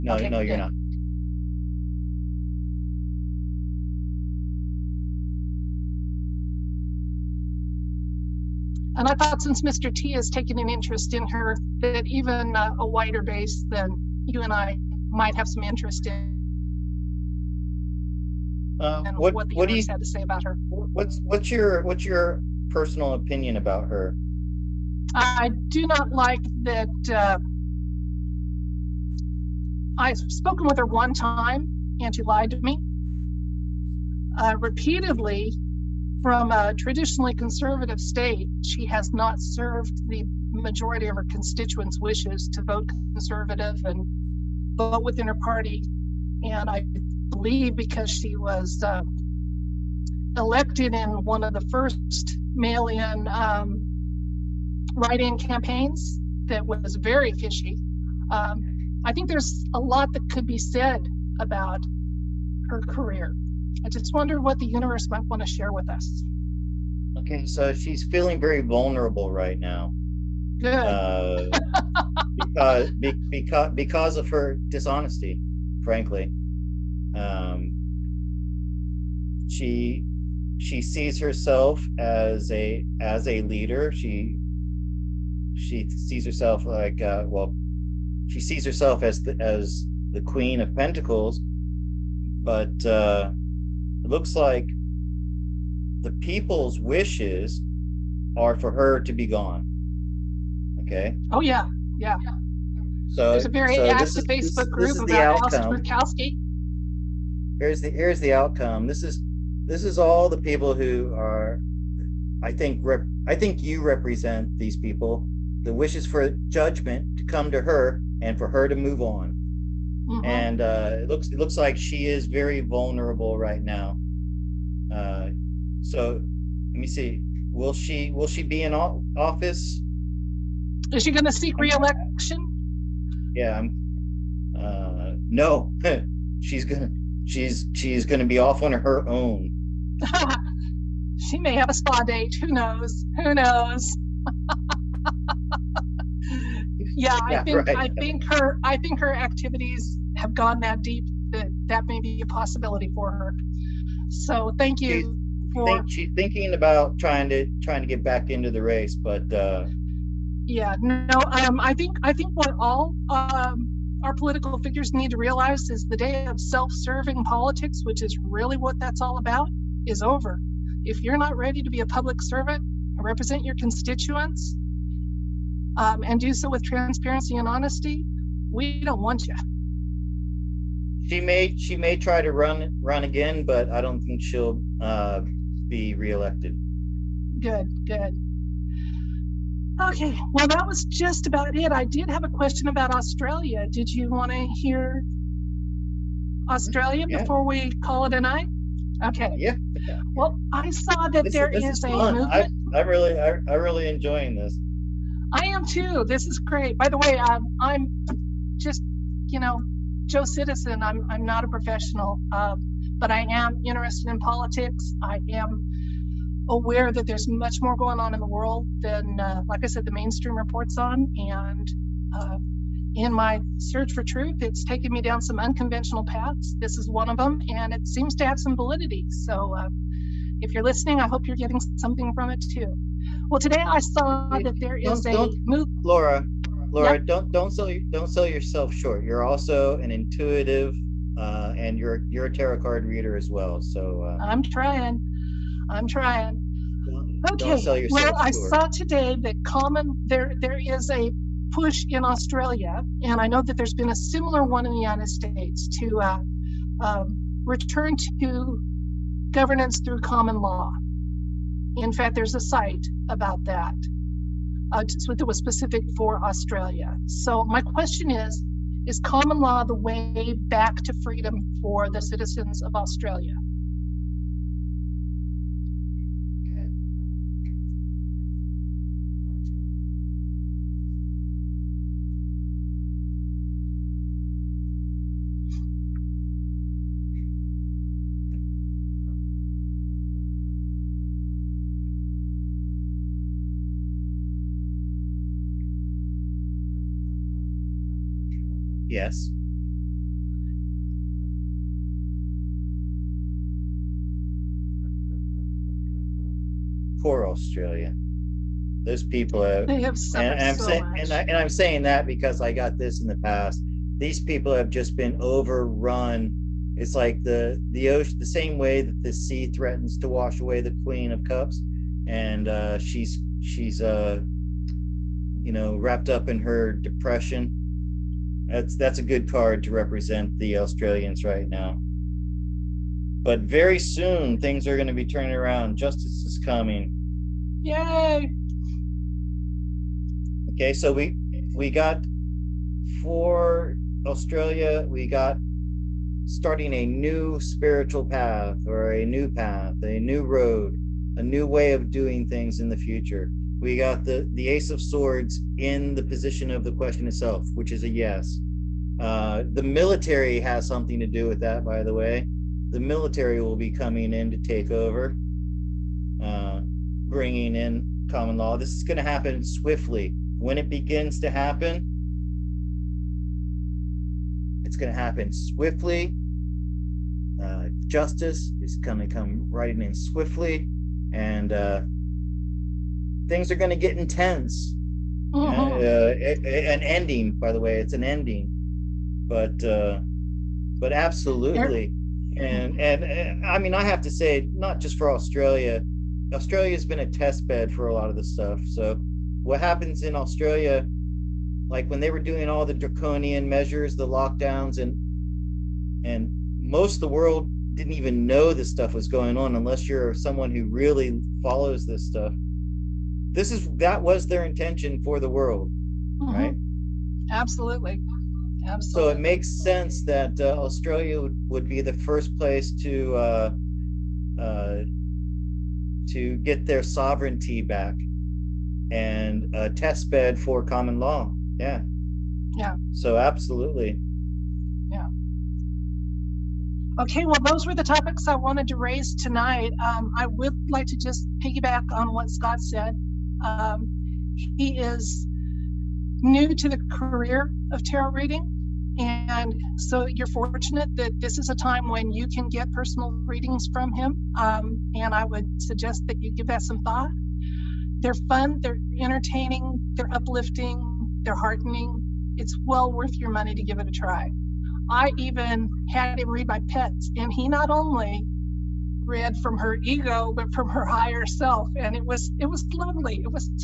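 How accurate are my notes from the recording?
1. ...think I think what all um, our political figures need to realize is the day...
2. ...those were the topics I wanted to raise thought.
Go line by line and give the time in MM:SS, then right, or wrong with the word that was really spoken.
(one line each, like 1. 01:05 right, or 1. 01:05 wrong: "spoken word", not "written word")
1. 02:41 right
2. 07:17 wrong: "tonight", not "thought".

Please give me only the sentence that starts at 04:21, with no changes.
In fact, there's a site about that uh, it was specific for Australia.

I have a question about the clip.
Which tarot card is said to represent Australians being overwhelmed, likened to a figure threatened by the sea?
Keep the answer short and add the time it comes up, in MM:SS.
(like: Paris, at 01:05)
Queen of Cups, at 05:20.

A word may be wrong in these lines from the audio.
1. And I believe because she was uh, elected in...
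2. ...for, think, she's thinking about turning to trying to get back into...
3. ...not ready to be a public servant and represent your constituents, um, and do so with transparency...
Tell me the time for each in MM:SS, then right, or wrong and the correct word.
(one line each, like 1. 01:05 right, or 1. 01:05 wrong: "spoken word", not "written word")
1. 00:46 right
2. 02:35 wrong: "trying", not "turning"
3. 02:51 right.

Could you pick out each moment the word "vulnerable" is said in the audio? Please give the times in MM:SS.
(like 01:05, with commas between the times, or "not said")
01:08, 02:02.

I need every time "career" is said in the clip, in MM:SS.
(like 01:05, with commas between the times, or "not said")
01:02, 07:26.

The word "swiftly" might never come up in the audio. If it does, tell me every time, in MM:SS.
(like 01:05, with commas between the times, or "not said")
06:09, 06:15, 06:19.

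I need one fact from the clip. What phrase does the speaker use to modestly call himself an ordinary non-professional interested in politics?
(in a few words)
Joe Citizen.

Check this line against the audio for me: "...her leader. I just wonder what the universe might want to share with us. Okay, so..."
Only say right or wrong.
wrong.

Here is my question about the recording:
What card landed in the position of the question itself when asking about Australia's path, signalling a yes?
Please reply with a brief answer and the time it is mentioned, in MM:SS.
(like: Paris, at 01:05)
Ace of Swords, at 05:54.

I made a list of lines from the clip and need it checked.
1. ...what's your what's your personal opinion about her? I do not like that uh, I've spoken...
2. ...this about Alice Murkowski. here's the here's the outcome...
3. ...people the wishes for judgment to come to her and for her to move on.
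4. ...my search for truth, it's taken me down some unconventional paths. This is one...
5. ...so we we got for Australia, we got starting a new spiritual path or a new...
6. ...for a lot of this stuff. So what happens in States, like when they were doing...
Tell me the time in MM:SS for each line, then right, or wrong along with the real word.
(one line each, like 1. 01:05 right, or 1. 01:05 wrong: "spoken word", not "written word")
1. 00:21 right
2. 01:44 right
3. 01:54 right
4. 03:43 right
5. 05:40 right
6. 06:37 wrong: "Australia", not "States".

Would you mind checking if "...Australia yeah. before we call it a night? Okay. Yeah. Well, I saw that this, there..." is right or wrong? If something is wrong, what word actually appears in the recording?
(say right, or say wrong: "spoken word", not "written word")
right.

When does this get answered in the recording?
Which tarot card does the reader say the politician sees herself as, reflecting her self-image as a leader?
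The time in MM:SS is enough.
01:30.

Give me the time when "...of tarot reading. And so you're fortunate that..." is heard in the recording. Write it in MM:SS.
07:27.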